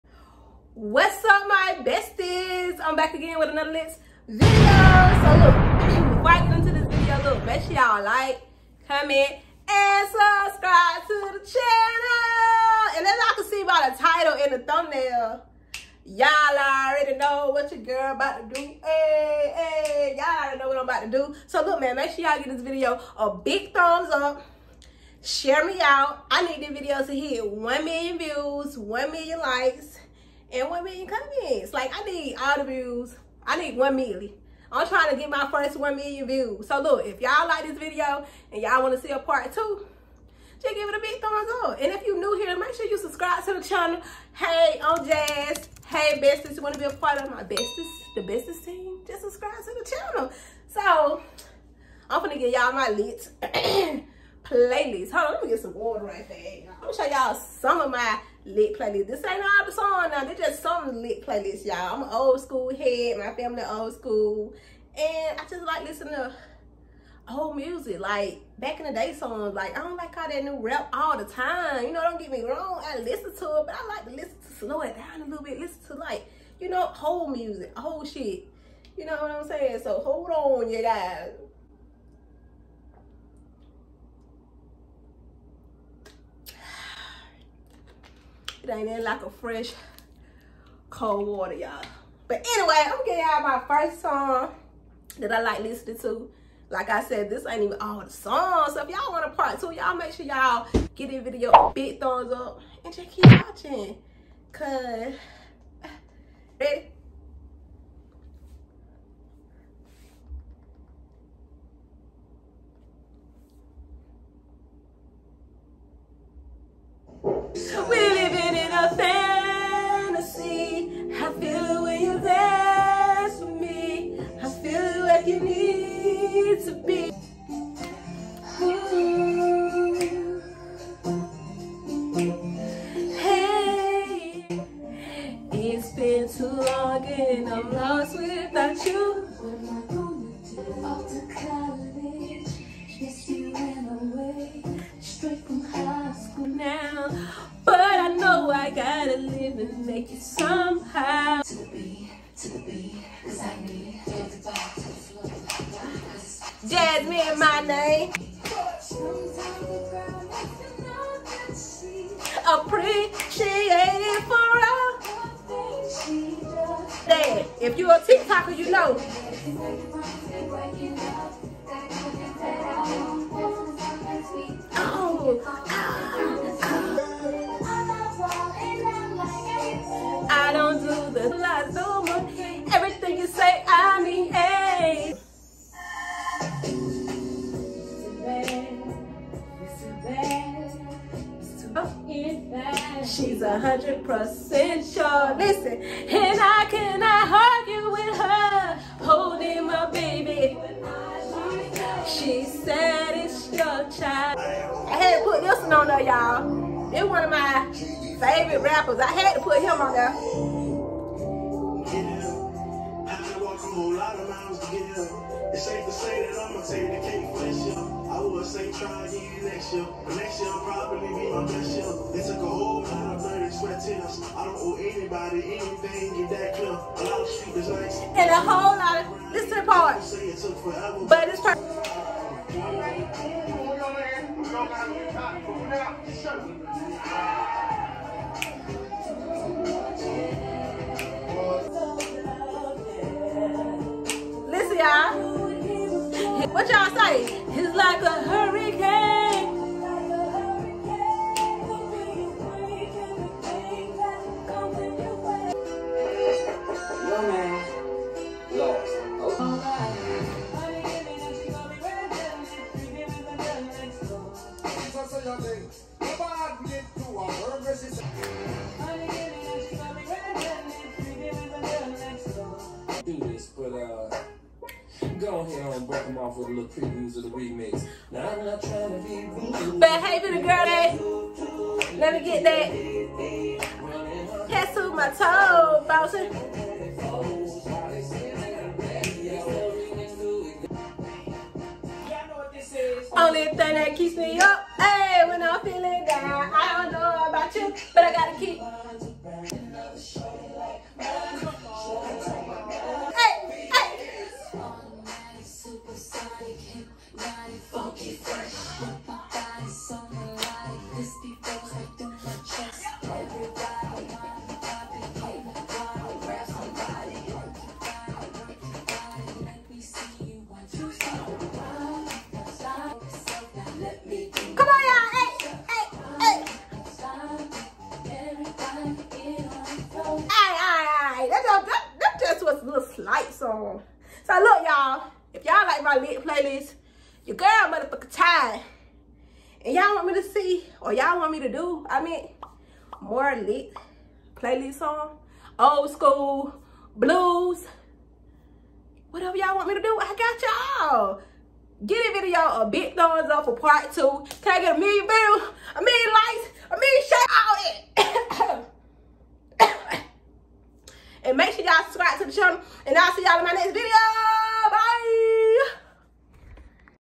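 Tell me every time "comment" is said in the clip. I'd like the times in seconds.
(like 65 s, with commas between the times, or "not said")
8 s, 31 s.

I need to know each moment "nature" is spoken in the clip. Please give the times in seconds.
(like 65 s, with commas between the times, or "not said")
not said.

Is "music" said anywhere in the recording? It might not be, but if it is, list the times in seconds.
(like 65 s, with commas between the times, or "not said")
67 s, 77 s.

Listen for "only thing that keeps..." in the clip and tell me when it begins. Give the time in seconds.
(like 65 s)
293 s.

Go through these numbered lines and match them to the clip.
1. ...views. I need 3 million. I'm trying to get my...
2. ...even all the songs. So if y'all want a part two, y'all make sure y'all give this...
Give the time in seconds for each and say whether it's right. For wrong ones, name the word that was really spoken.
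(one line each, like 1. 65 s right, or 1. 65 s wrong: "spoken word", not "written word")
1. 32 s wrong: "1", not "3"
2. 97 s right.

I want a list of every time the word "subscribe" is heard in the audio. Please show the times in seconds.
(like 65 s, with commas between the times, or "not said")
10 s, 42 s, 49 s.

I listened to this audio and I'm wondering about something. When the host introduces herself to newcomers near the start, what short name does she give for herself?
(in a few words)
Jazz.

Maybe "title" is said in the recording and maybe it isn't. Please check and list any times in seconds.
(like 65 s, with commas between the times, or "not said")
14 s.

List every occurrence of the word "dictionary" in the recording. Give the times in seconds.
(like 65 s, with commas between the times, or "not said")
not said.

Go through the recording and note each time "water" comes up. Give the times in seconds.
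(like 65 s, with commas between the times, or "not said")
55 s, 91 s.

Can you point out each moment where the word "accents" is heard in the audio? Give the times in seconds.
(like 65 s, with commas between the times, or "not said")
not said.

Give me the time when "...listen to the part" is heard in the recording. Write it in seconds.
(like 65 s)
229 s.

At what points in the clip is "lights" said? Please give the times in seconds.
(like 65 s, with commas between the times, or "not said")
333 s.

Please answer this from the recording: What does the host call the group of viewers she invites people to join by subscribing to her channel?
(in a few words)
the besties team.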